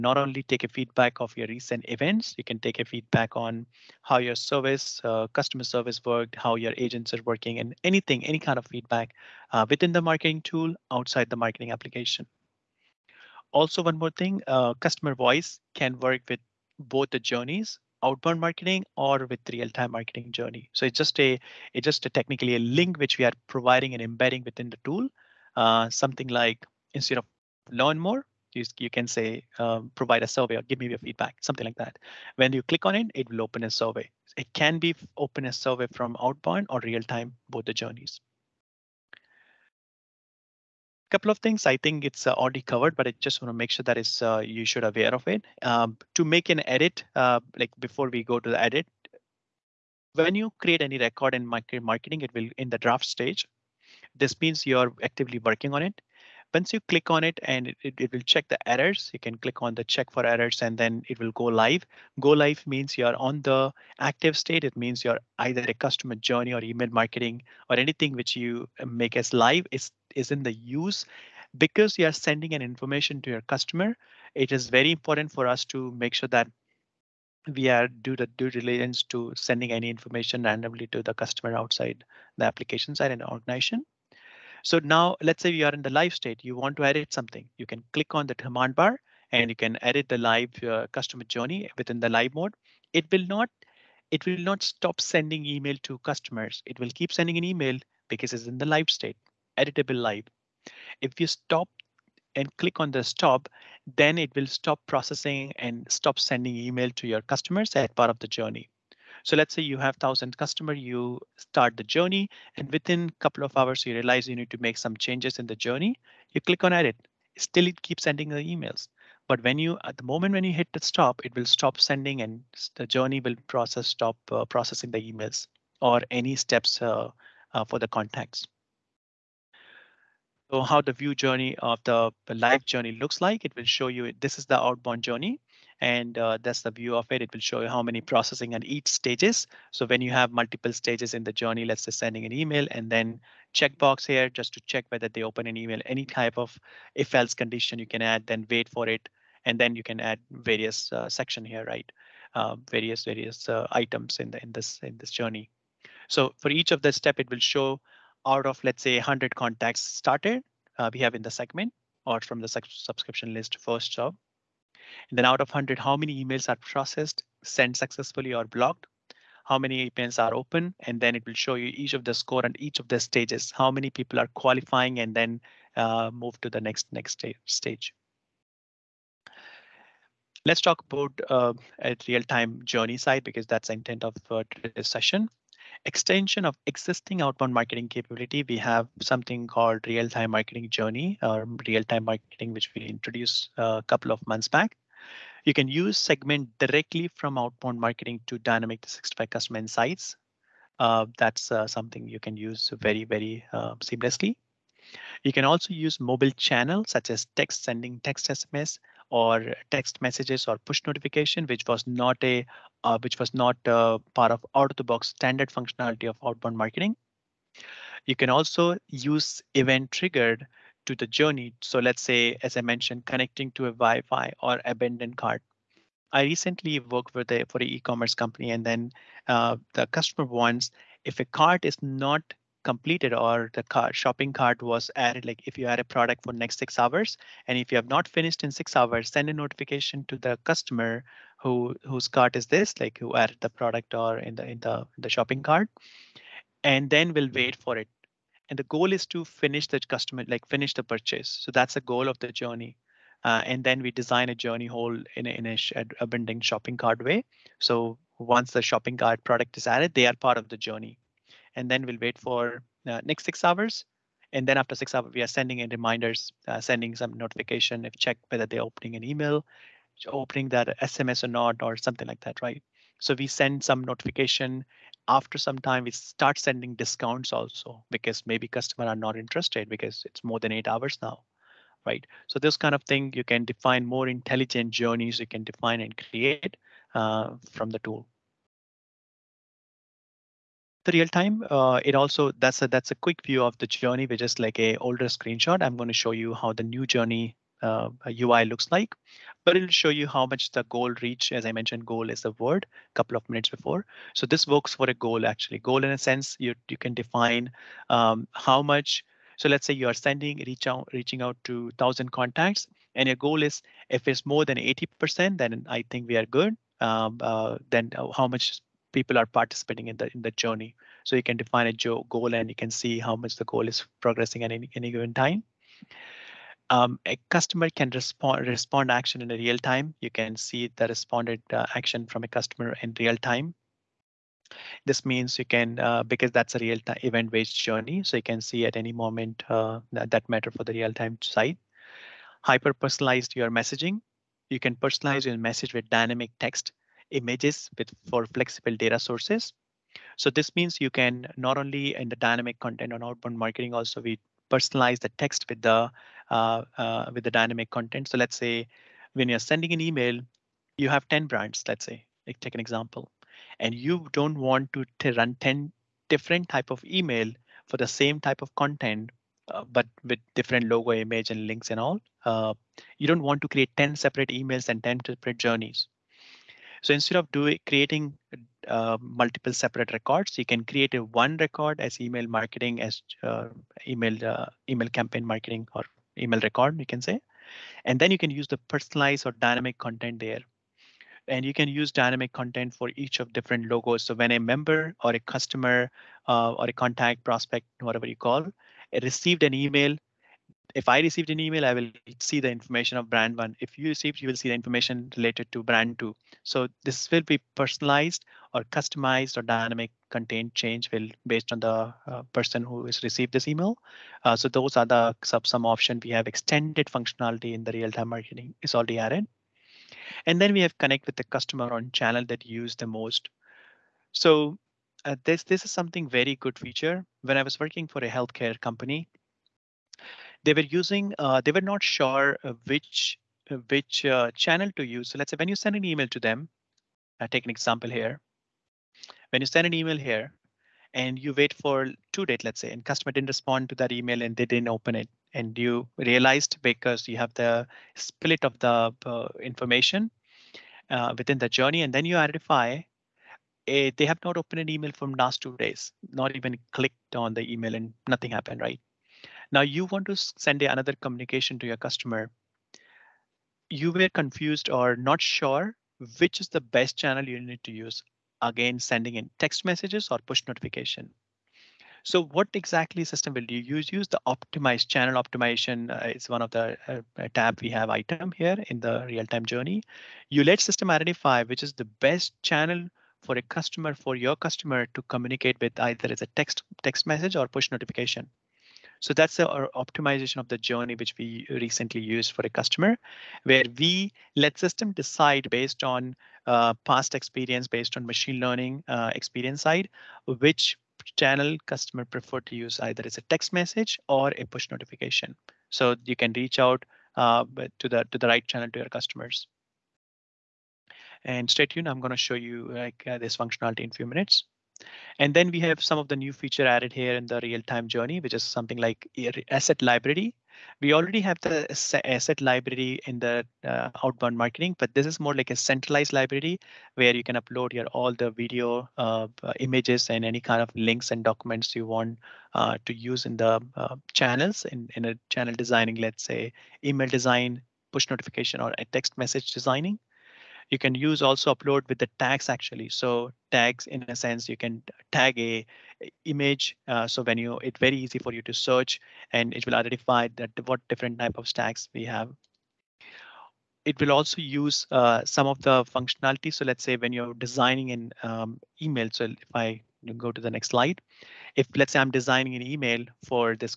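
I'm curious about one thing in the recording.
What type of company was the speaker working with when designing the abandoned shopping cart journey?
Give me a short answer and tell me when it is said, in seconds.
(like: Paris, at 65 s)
e-commerce company, at 227 s.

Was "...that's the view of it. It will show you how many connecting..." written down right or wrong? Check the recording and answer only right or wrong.
wrong.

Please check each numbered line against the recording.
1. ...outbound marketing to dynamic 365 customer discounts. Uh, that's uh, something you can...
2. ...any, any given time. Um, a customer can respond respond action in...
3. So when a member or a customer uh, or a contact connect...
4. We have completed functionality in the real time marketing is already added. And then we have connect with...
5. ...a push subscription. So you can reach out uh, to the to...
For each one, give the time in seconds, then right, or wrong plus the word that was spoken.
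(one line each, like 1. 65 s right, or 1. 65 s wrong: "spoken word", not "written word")
1. 197 s wrong: "insights", not "discounts"
2. 324 s right
3. 394 s wrong: "prospect", not "connect"
4. 416 s wrong: "extended", not "completed"
5. 504 s wrong: "notification", not "subscription".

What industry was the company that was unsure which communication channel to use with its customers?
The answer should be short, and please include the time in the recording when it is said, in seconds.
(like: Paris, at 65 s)
healthcare, at 428 s.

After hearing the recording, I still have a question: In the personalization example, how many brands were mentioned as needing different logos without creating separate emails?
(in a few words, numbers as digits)
10.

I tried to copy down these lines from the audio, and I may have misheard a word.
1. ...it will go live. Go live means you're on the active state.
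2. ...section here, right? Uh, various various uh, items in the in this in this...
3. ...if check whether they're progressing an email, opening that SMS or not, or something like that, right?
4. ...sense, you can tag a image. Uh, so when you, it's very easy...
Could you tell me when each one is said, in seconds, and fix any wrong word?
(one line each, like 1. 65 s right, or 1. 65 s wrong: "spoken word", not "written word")
1. 61 s right
2. 151 s right
3. 267 s wrong: "opening", not "progressing"
4. 544 s right.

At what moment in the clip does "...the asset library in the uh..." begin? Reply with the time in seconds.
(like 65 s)
521 s.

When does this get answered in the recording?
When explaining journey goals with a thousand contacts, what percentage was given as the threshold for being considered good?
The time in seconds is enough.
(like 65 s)
314 s.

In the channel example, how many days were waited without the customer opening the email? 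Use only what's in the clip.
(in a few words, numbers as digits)
2.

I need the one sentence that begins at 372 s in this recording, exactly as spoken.
Uh, you don't want to create 10 separate emails and 10 separate journeys.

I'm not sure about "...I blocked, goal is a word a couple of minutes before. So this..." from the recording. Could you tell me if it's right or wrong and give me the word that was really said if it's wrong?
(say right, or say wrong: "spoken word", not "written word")
wrong: "mentioned", not "blocked".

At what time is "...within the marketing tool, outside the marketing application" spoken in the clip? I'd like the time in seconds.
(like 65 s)
9 s.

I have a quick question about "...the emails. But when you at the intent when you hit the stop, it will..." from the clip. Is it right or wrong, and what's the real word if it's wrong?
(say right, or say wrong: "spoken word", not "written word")
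wrong: "moment", not "intent".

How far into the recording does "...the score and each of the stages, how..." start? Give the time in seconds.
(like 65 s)
172 s.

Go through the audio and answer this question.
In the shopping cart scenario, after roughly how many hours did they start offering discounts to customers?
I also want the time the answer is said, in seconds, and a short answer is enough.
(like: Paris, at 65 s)
8, at 280 s.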